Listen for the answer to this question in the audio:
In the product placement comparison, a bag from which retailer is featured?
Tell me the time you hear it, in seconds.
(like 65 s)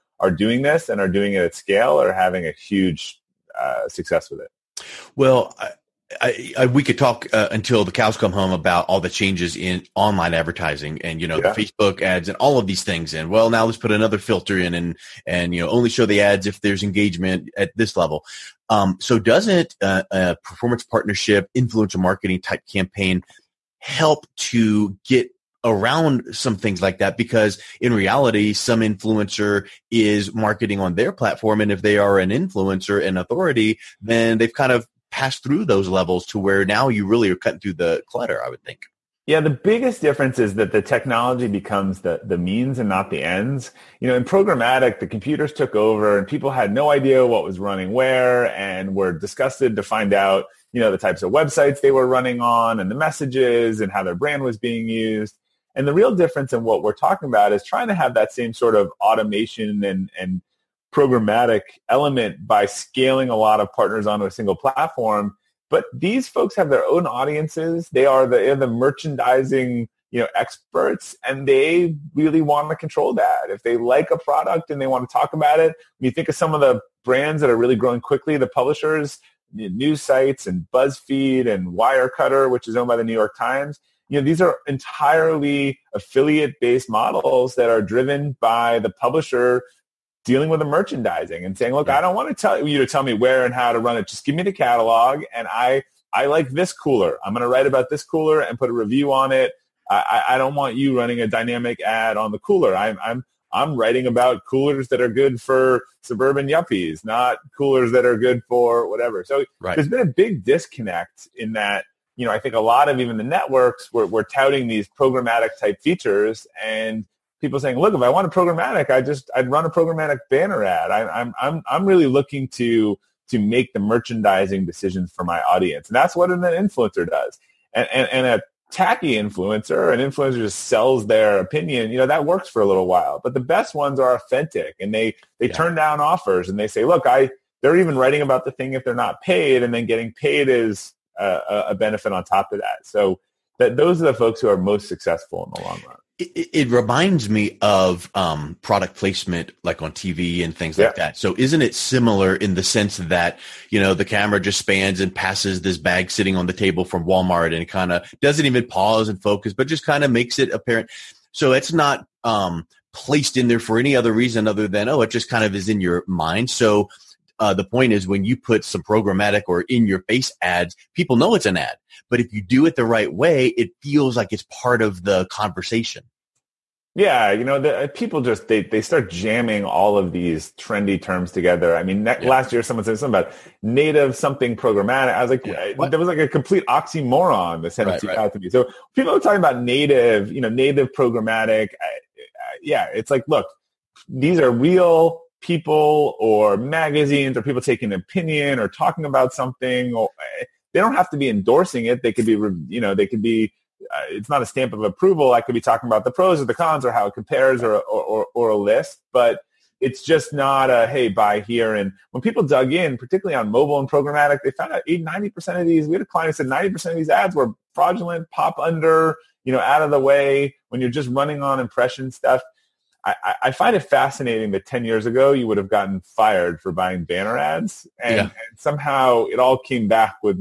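157 s.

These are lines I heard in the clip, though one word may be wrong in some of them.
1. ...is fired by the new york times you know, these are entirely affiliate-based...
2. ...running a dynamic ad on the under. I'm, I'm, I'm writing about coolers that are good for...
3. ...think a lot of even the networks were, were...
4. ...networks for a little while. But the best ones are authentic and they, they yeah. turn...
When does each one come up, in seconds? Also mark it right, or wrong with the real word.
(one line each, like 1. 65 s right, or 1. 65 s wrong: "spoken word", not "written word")
1. 82 s wrong: "owned", not "fired"
2. 100 s wrong: "cooler", not "under"
3. 112 s right
4. 132 s wrong: "works", not "networks".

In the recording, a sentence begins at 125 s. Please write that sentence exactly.
And that's what an influencer does.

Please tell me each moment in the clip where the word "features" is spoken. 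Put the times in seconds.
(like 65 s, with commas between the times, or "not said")
115 s.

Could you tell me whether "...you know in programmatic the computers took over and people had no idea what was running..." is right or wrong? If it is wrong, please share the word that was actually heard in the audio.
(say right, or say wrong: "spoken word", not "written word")
right.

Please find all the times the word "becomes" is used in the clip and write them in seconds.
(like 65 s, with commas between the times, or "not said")
41 s.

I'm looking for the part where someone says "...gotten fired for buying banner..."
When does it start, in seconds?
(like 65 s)
225 s.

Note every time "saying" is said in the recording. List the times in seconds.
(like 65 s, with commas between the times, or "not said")
91 s, 117 s.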